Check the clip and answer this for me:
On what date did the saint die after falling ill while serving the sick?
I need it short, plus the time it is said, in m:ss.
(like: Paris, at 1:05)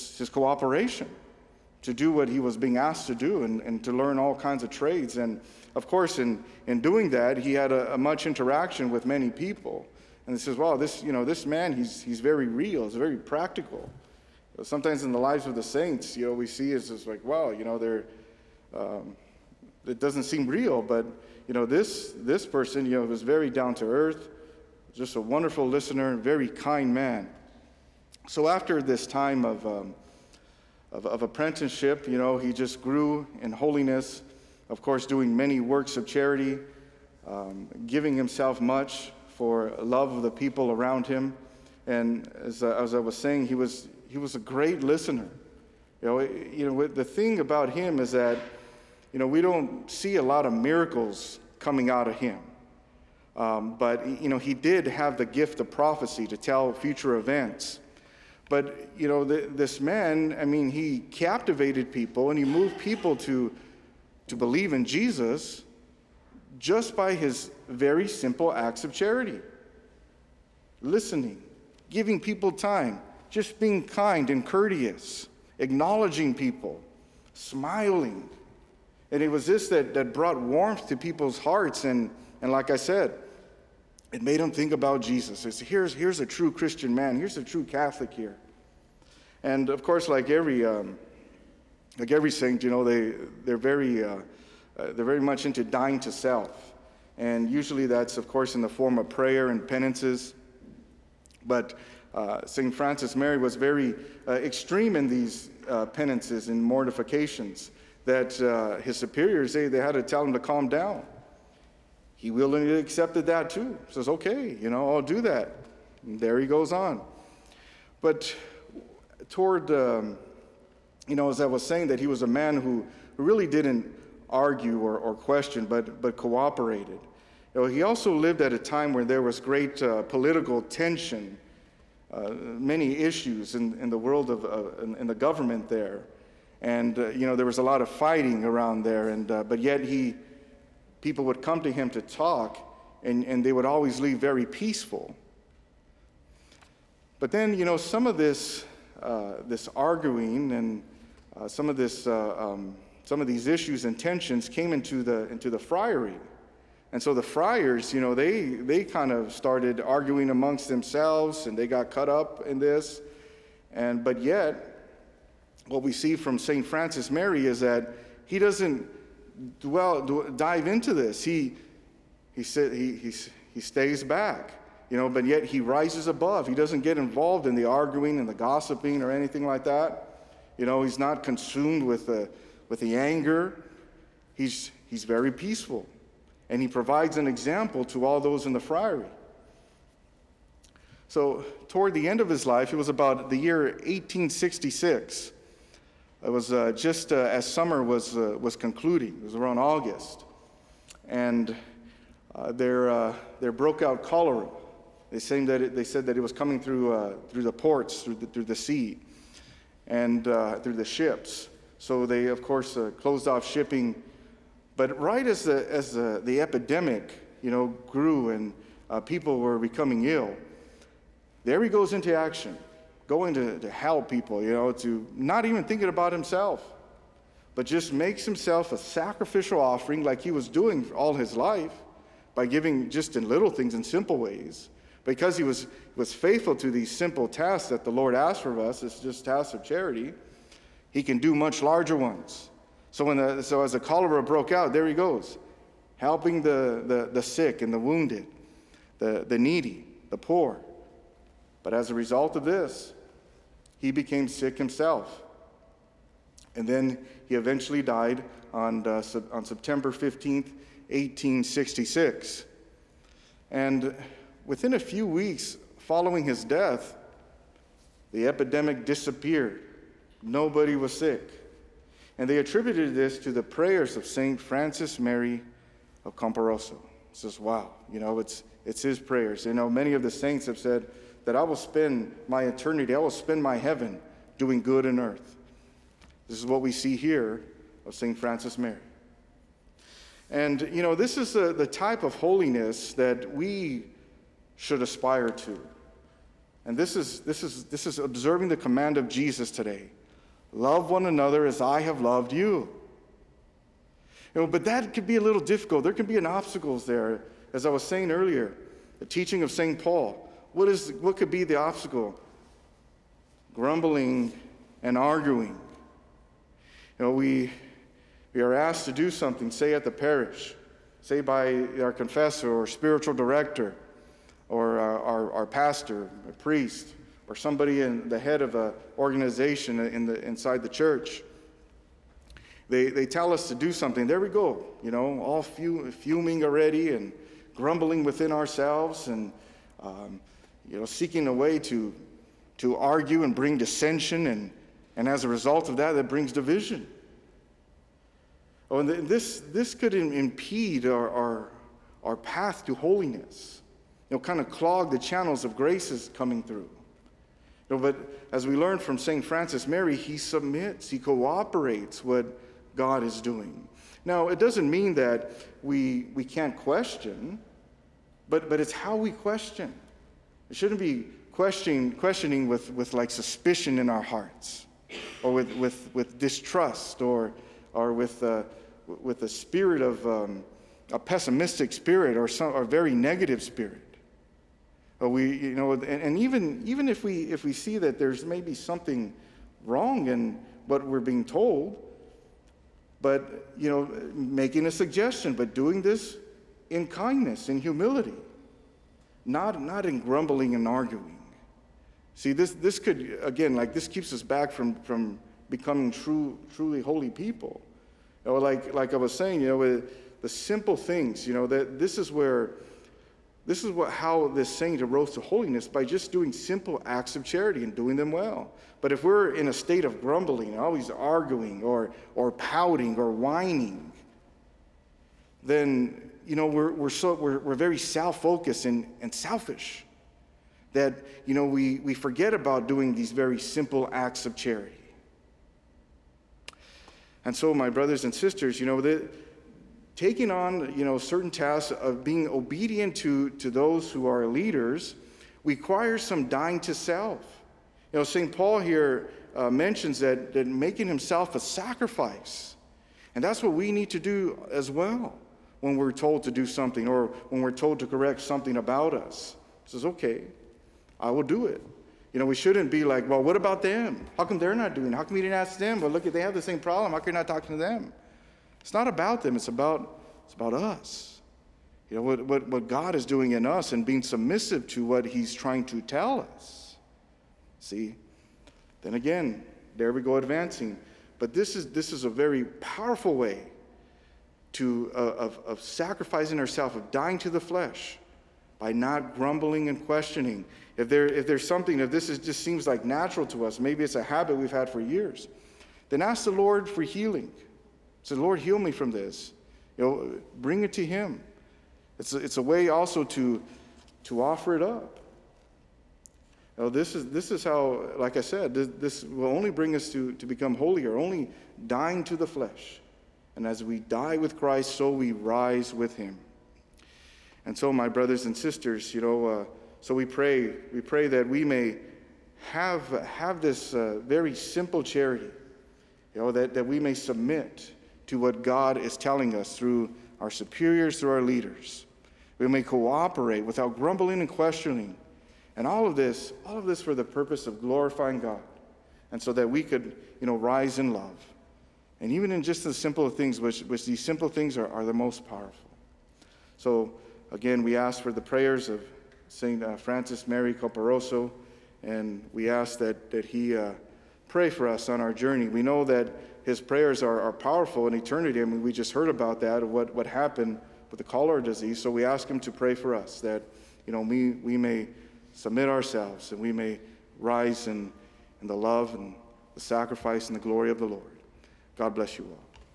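September 15, at 4:19.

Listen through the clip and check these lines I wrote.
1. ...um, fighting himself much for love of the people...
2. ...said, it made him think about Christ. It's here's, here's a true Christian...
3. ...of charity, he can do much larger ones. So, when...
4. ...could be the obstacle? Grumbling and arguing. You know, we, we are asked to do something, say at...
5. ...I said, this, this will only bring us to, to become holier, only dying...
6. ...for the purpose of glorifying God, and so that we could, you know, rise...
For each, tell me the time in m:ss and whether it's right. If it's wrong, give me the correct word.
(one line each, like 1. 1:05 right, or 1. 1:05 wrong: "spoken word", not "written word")
1. 0:37 wrong: "giving", not "fighting"
2. 1:22 wrong: "Jesus", not "Christ"
3. 3:59 right
4. 5:11 right
5. 8:28 right
6. 8:56 right.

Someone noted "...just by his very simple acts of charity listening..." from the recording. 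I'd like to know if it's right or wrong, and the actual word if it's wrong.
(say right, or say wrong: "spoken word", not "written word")
right.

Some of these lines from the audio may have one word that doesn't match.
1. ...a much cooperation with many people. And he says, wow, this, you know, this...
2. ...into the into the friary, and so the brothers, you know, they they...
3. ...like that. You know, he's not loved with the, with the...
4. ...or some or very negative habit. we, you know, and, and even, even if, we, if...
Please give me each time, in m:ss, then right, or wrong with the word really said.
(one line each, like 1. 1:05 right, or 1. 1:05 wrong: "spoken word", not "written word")
1. 0:07 wrong: "interaction", not "cooperation"
2. 2:34 wrong: "friars", not "brothers"
3. 2:59 wrong: "consumed", not "loved"
4. 6:22 wrong: "spirit", not "habit".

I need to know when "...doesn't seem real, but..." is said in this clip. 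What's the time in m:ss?
0:19.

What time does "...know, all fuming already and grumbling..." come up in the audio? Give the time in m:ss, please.
5:34.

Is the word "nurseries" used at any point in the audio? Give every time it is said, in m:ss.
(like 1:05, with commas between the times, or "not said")
not said.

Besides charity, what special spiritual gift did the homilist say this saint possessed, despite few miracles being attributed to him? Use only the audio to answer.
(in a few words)
prophecy.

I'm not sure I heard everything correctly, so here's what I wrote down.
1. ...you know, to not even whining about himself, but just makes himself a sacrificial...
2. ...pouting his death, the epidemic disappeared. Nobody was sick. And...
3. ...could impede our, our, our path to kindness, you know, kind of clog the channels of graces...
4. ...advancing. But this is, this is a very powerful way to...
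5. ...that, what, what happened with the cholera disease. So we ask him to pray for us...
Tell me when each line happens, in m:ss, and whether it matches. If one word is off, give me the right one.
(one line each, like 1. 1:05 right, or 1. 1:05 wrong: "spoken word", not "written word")
1. 3:44 wrong: "thinking", not "whining"
2. 4:25 wrong: "following", not "pouting"
3. 5:49 wrong: "holiness", not "kindness"
4. 8:00 right
5. 9:19 right.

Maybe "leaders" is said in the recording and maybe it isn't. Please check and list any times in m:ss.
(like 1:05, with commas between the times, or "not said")
7:24, 8:51.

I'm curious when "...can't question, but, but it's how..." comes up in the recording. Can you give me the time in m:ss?
6:06.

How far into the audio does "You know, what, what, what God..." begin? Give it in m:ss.
7:51.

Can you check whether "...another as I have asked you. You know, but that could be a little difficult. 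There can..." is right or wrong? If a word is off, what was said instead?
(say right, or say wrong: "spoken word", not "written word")
wrong: "loved", not "asked".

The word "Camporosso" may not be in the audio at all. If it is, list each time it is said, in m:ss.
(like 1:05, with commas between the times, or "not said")
4:36, 9:10.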